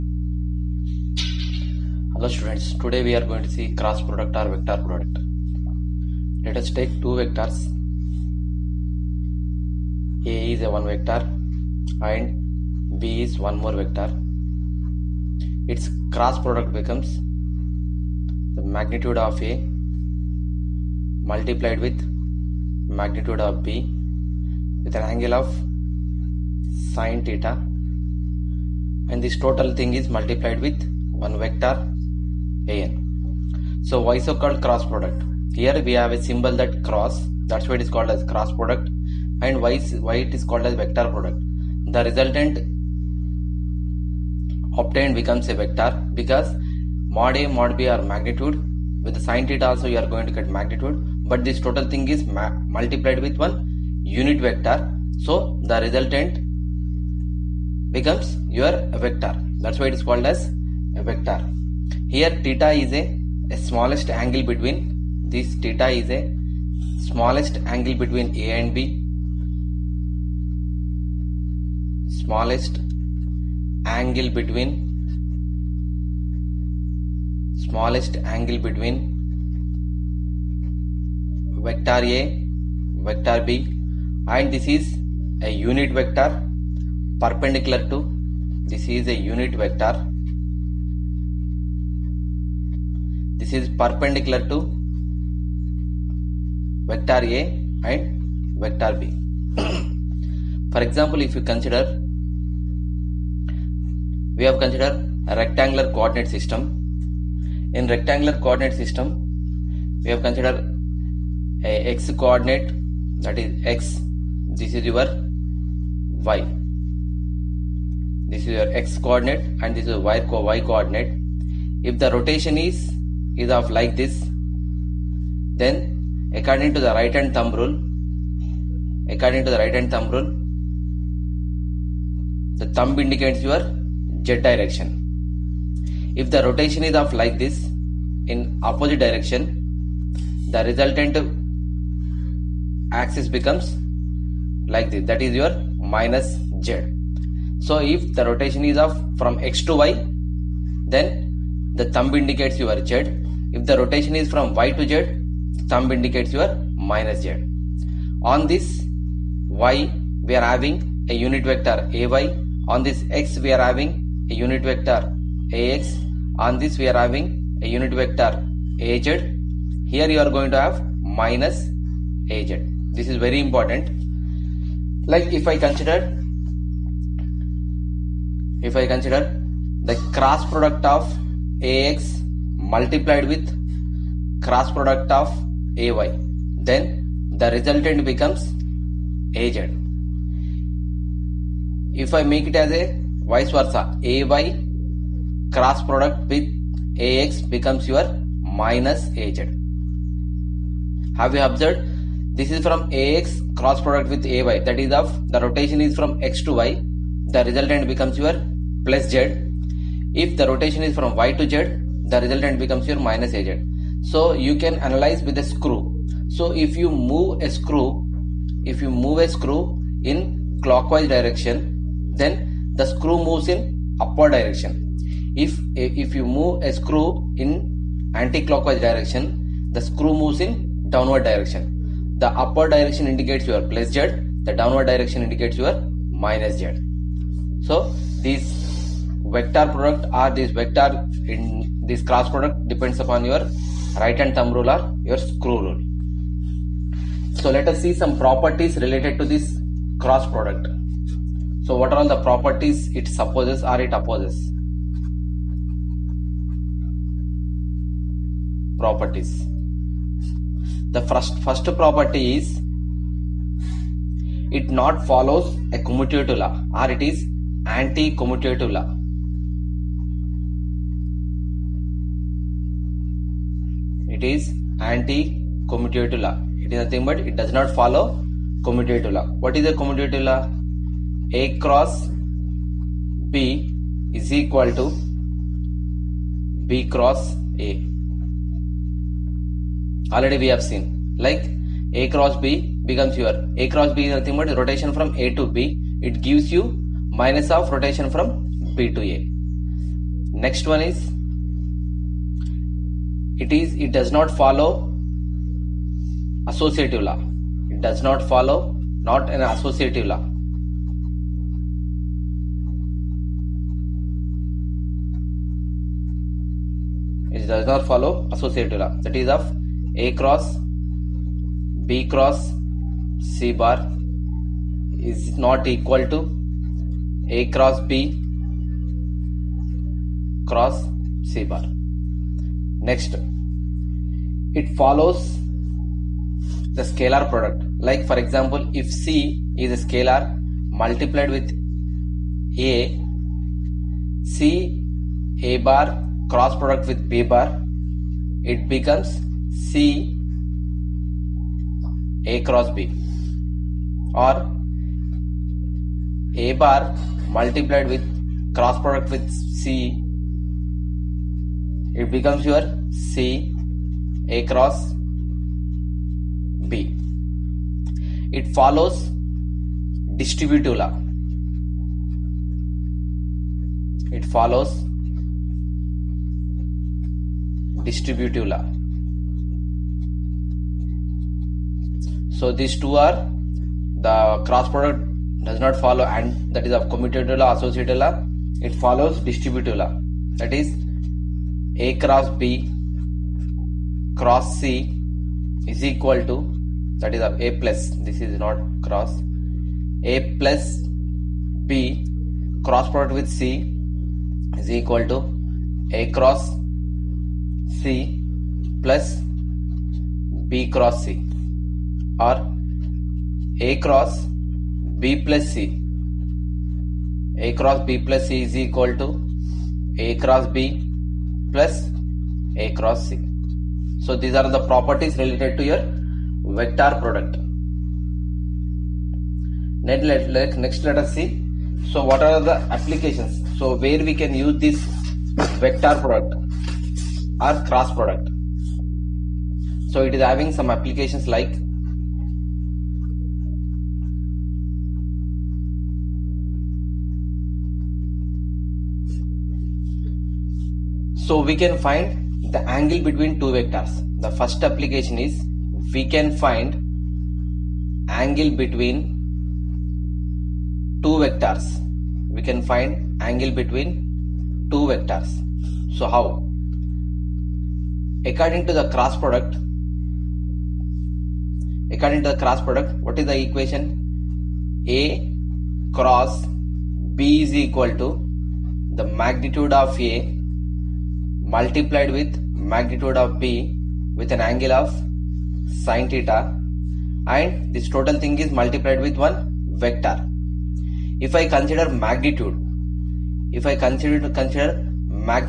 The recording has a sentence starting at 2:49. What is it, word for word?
Here you are going to have minus az.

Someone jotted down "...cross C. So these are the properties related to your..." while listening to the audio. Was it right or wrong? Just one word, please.
right.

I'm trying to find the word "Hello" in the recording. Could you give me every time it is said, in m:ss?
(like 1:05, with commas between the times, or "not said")
0:02.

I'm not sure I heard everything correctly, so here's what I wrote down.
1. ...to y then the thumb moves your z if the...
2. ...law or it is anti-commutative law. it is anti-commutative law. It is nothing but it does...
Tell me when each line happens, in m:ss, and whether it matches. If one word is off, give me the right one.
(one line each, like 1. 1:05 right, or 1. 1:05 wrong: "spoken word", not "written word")
1. 2:29 wrong: "indicates", not "moves"
2. 4:26 right.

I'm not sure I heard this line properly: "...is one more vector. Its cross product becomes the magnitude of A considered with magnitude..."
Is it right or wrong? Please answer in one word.
wrong.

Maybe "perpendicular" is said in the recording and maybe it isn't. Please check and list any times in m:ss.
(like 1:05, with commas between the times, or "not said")
1:27, 1:33.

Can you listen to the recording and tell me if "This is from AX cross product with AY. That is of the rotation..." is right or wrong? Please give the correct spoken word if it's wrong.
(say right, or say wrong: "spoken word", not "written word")
right.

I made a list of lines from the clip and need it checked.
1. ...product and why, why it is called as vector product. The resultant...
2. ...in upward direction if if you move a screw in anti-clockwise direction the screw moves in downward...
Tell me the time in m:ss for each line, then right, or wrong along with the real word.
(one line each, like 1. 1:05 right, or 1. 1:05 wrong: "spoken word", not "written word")
1. 0:38 right
2. 3:43 right.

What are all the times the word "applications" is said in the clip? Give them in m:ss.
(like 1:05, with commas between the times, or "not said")
7:12, 7:20, 7:34.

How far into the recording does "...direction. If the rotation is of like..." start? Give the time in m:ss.
2:14.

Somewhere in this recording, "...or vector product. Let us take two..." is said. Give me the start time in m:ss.
0:04.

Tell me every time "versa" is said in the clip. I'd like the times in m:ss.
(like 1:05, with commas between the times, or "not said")
3:13.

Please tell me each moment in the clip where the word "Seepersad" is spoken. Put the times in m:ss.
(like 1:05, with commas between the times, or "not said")
not said.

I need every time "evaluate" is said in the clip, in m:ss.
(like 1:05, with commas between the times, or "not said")
not said.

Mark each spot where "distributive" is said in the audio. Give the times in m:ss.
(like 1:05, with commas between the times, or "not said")
6:10, 6:17, 6:29.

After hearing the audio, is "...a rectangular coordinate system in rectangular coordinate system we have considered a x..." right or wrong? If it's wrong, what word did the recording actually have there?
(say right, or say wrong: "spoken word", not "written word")
right.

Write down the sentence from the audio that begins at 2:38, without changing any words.
On this y, we are having a unit vector ay.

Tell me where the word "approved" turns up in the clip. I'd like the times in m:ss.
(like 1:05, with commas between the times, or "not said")
not said.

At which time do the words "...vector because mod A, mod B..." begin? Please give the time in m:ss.
0:45.